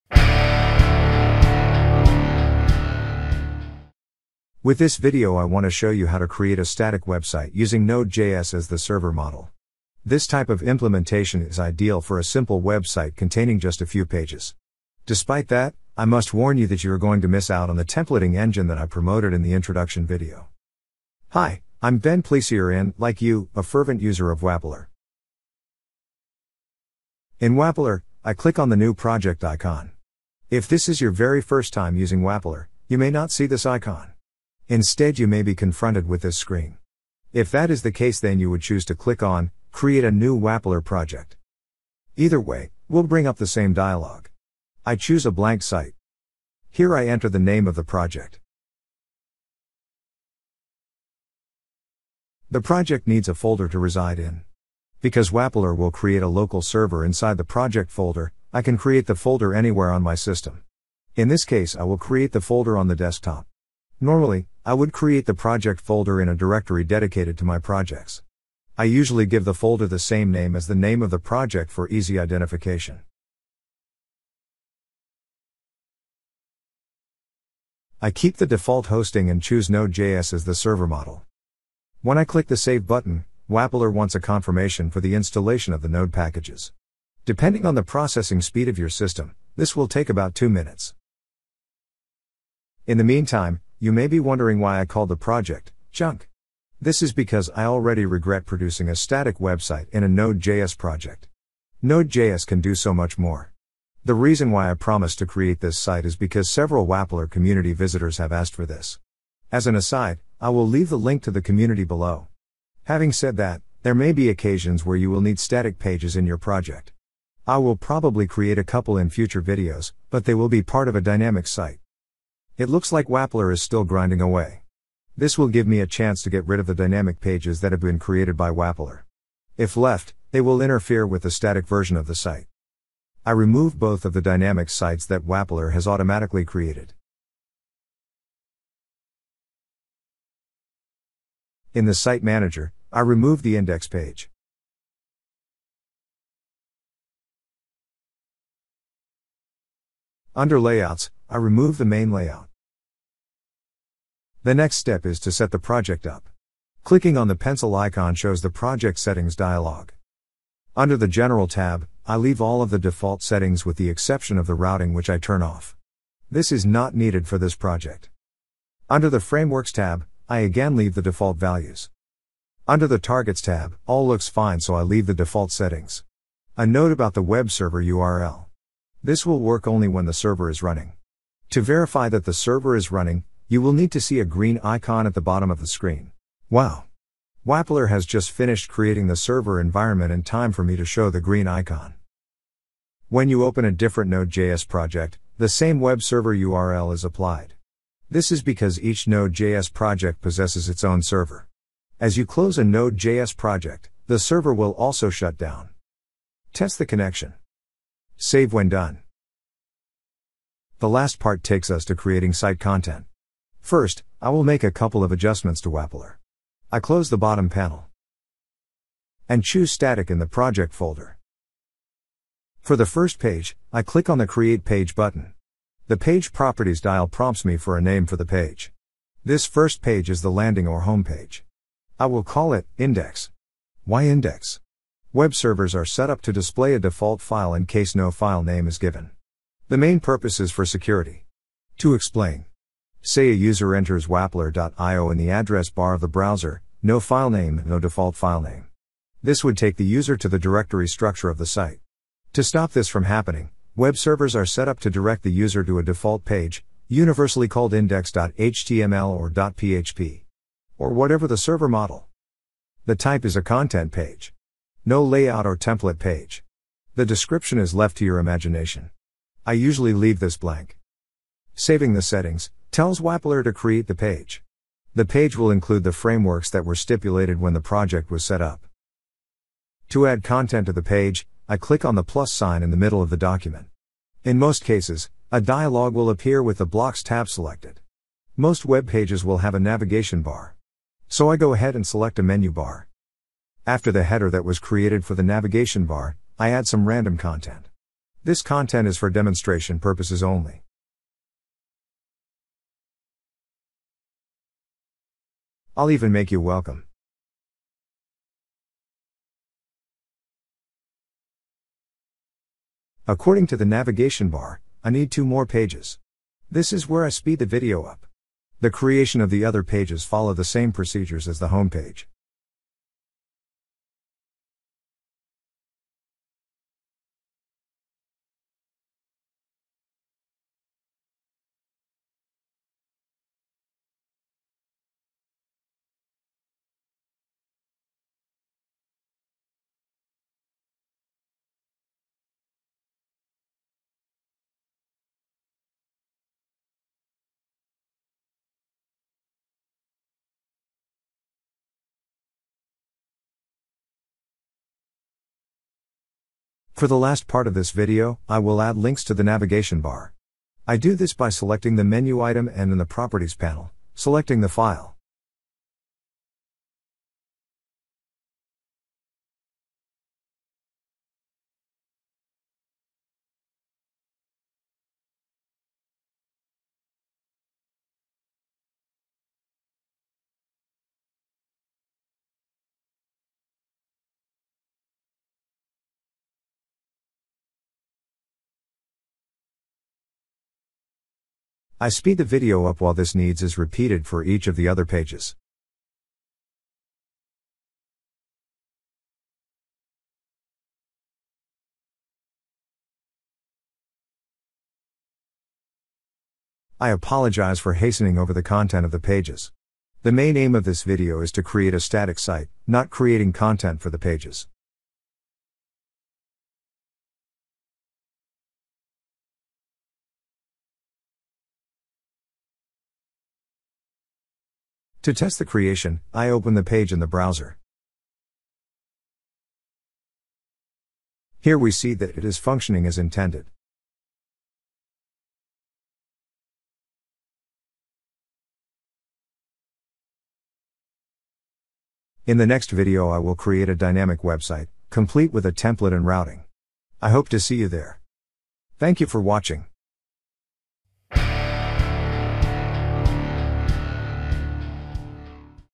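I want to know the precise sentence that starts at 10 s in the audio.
This type of implementation is ideal for a simple website containing just a few pages.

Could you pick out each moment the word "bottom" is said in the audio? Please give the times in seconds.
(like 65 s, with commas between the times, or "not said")
185 s, 217 s.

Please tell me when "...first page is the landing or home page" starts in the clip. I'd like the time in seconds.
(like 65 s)
229 s.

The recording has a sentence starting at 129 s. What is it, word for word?
If left, they will interfere with the static version of the site.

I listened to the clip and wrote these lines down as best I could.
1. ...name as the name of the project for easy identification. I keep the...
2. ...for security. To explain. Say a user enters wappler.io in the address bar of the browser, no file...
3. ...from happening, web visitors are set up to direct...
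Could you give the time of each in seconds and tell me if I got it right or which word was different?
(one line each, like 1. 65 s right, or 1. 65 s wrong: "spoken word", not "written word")
1. 70 s right
2. 240 s right
3. 252 s wrong: "servers", not "visitors".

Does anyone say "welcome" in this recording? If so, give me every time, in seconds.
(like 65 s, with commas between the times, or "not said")
306 s.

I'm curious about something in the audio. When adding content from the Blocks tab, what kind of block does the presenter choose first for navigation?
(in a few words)
menu bar.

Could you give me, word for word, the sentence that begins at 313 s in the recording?
According to the navigation bar, I need two more pages.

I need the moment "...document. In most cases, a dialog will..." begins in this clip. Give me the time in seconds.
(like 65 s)
283 s.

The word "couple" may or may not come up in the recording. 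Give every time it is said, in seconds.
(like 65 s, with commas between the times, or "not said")
118 s, 214 s.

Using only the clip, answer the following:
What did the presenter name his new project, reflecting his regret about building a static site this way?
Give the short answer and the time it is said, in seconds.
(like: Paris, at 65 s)
junk, at 95 s.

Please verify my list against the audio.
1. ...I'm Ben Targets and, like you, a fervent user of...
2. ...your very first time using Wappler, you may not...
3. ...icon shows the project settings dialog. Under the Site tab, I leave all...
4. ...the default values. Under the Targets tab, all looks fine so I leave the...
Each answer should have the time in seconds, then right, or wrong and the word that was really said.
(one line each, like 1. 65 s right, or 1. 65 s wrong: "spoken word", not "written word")
1. 21 s wrong: "Pleysier", not "Targets"
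2. 31 s right
3. 157 s wrong: "General", not "Site"
4. 170 s right.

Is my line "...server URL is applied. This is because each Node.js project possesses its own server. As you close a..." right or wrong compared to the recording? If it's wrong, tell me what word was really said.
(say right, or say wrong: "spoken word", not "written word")
right.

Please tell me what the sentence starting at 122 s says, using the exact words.
It looks like Wappler is still grinding away.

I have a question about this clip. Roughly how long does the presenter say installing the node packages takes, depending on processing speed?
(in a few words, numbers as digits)
2 minutes.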